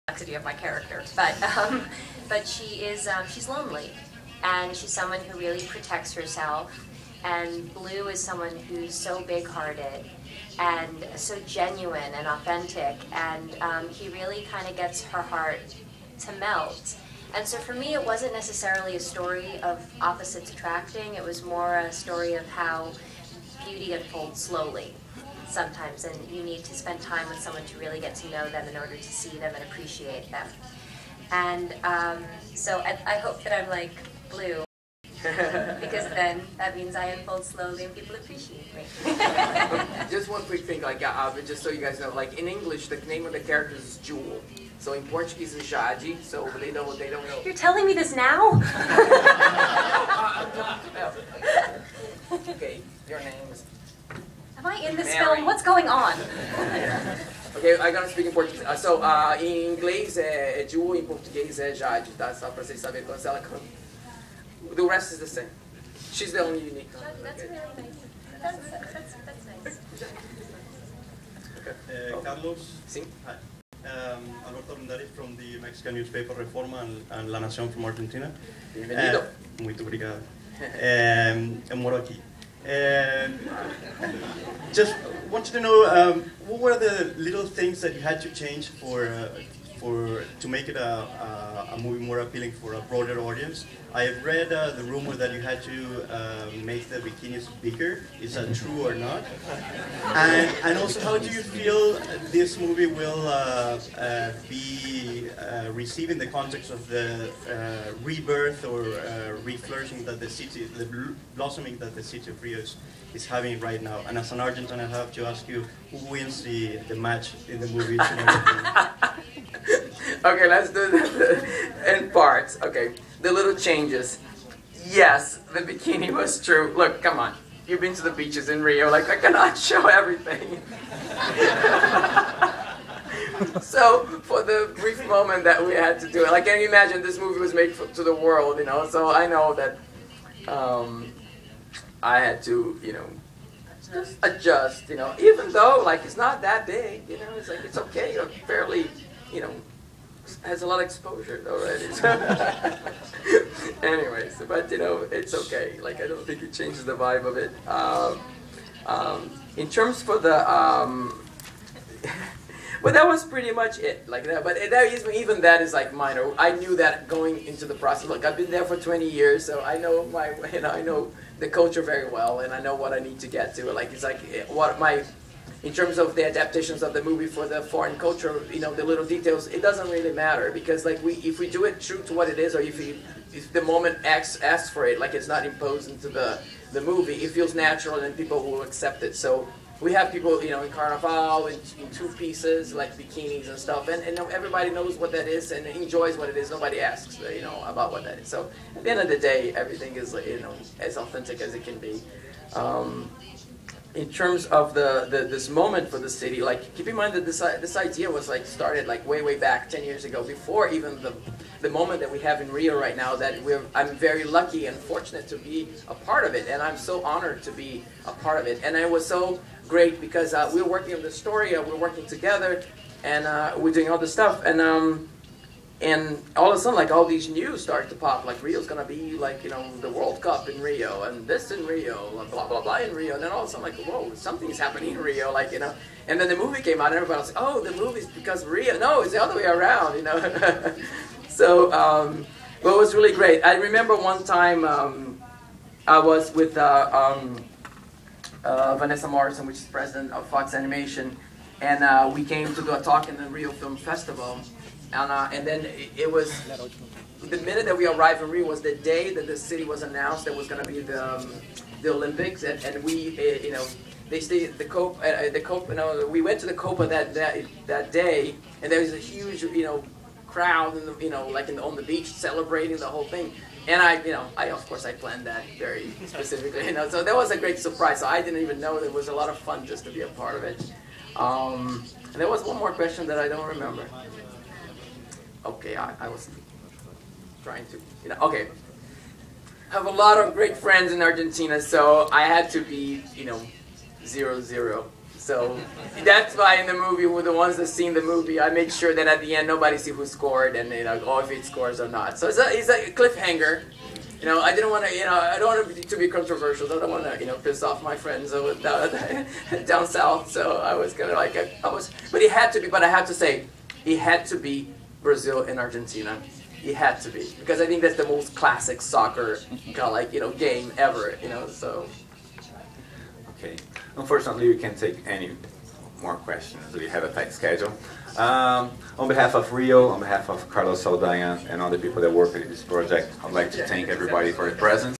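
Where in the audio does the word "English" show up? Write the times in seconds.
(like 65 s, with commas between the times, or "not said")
42 s, 59 s.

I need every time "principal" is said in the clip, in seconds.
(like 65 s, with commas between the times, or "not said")
not said.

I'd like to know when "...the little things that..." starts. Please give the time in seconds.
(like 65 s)
86 s.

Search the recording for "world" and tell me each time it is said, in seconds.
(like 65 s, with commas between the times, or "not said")
138 s, 229 s.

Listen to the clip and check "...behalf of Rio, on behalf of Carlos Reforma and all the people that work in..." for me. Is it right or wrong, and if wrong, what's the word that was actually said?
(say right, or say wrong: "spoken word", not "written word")
wrong: "Saldanha", not "Reforma".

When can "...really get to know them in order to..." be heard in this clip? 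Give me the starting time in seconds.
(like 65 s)
27 s.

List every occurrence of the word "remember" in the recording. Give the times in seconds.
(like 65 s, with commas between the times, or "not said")
243 s, 283 s.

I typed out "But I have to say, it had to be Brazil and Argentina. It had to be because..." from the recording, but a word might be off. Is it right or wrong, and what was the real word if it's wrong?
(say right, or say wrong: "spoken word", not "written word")
right.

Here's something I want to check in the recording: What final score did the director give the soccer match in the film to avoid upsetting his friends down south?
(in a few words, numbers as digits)
0-0.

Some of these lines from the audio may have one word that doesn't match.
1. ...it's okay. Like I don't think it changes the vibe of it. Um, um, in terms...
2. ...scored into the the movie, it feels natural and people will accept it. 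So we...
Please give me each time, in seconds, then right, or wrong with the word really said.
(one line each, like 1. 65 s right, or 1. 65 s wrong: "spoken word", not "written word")
1. 155 s right
2. 185 s wrong: "imposed", not "scored".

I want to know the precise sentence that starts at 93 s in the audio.
I have read uh, the rumor that you had to uh, make the bikinis bigger.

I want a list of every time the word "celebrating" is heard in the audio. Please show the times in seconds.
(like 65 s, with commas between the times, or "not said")
272 s.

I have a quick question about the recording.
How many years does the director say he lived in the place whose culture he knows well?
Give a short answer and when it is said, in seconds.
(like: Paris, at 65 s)
20, at 168 s.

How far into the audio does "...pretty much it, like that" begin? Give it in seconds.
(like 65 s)
163 s.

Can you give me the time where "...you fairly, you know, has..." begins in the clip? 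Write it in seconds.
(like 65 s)
148 s.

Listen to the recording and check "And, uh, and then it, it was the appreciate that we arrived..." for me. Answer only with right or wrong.
wrong.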